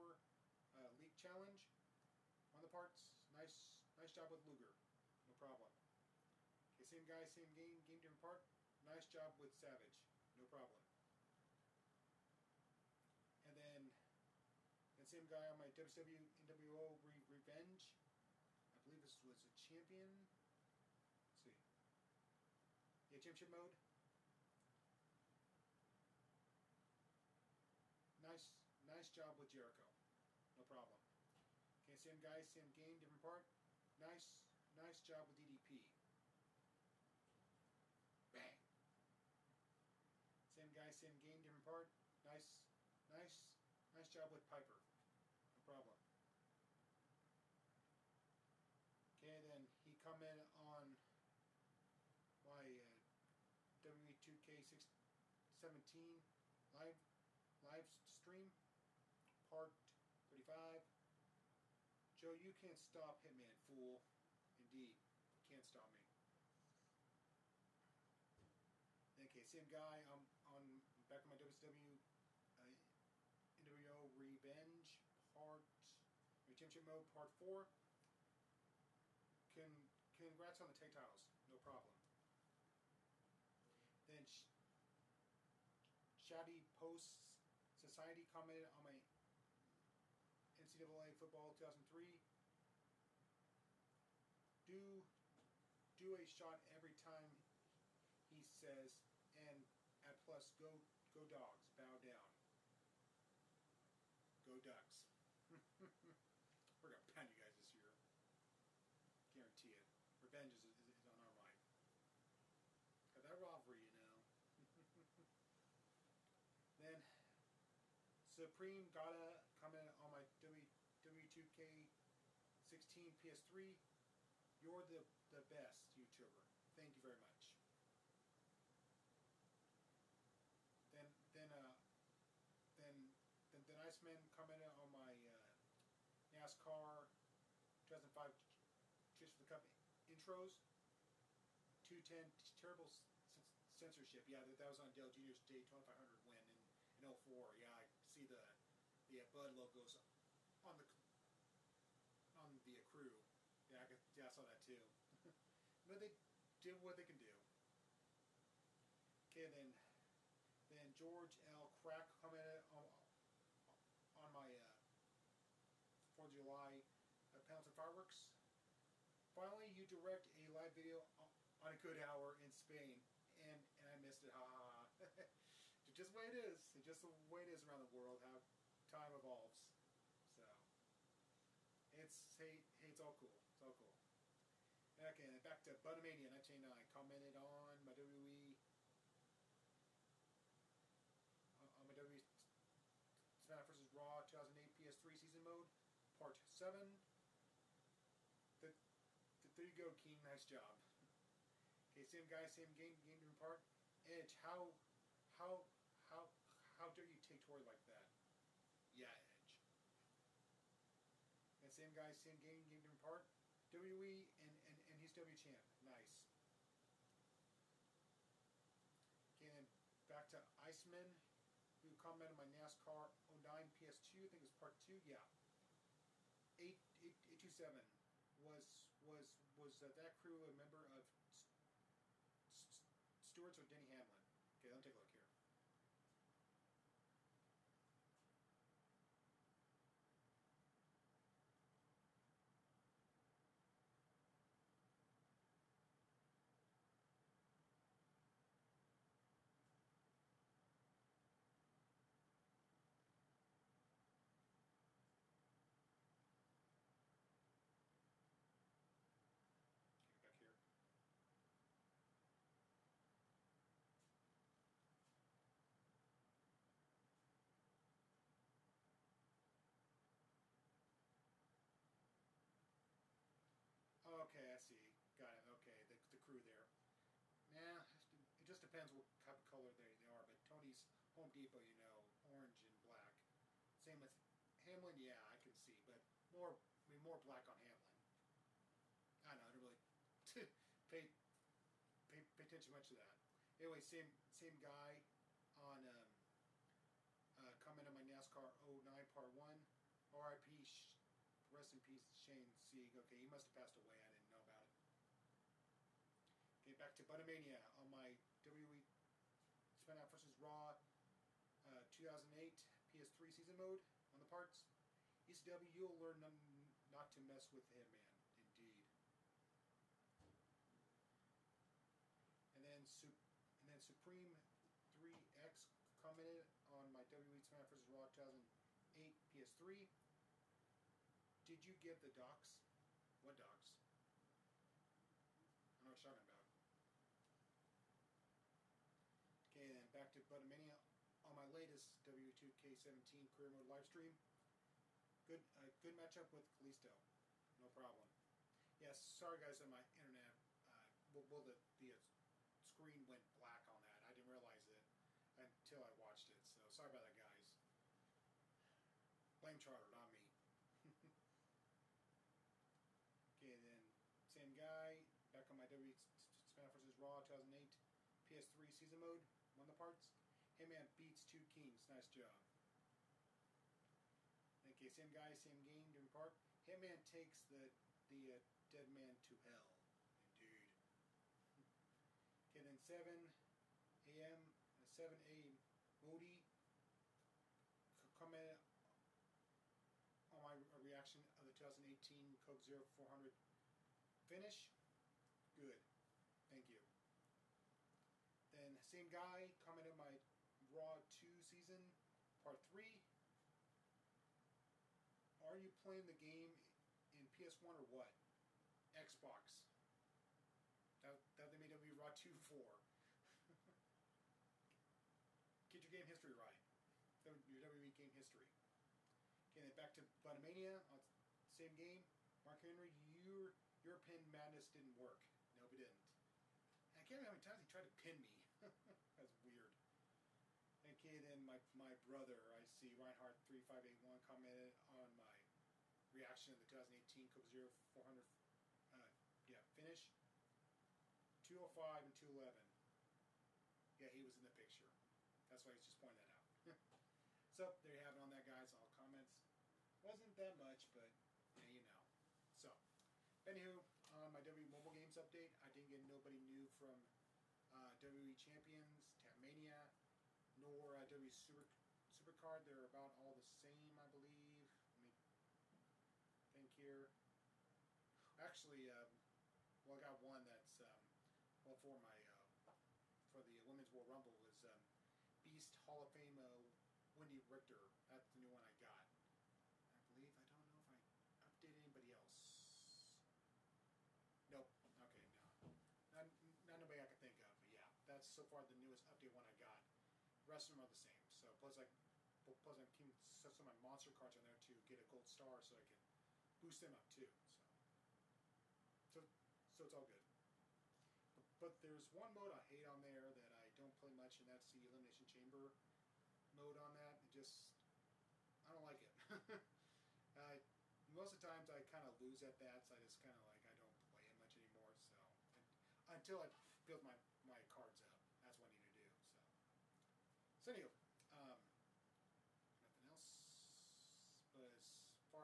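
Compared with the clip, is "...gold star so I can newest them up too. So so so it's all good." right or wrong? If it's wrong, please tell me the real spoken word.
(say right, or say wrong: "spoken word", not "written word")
wrong: "boost", not "newest".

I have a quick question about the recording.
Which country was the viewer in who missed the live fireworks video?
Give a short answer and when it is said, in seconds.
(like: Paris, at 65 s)
Spain, at 172 s.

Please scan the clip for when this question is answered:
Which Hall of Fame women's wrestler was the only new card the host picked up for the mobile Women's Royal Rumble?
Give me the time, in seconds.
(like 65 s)
477 s.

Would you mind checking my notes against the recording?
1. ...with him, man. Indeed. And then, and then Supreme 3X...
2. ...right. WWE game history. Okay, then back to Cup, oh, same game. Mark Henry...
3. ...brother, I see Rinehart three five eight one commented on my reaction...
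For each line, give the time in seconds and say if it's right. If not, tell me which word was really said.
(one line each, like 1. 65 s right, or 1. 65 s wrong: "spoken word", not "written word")
1. 317 s right
2. 416 s wrong: "Bottomania", not "Cup"
3. 431 s right.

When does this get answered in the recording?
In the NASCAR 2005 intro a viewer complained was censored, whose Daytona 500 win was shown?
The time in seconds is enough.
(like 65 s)
144 s.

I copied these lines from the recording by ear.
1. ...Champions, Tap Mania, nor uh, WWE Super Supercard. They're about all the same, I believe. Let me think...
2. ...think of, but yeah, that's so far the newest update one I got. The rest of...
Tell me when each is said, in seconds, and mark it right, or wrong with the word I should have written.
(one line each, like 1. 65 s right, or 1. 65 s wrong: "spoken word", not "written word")
1. 458 s right
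2. 487 s right.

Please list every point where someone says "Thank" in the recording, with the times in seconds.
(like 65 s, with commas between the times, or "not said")
126 s, 396 s.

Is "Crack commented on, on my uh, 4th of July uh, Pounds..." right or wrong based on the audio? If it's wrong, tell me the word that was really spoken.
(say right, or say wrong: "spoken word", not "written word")
right.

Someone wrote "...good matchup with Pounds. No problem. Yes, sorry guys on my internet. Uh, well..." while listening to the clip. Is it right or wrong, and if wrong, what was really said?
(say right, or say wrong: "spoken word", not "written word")
wrong: "Kalisto", not "Pounds".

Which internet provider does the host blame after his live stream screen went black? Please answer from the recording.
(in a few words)
Charter.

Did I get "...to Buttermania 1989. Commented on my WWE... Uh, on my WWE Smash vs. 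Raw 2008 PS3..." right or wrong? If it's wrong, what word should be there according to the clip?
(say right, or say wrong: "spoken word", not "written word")
right.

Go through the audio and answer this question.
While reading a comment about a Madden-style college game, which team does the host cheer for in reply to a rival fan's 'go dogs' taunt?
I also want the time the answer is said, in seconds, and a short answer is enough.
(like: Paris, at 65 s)
Ducks, at 104 s.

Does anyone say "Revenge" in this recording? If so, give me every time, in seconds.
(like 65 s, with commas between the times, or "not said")
17 s, 74 s, 110 s.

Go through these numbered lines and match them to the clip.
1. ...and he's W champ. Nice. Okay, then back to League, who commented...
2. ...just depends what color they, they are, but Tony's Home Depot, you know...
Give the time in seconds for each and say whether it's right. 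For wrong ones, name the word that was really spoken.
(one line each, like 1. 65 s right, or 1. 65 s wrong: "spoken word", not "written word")
1. 214 s wrong: "Iceman", not "League"
2. 278 s right.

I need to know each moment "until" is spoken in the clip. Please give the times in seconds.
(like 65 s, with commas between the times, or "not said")
355 s, 516 s.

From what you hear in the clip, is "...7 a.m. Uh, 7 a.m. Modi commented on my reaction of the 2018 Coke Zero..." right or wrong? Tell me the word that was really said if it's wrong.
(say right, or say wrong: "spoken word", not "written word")
right.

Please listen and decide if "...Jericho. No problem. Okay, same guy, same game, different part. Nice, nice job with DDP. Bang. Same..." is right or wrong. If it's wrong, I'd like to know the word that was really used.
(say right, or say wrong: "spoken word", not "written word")
right.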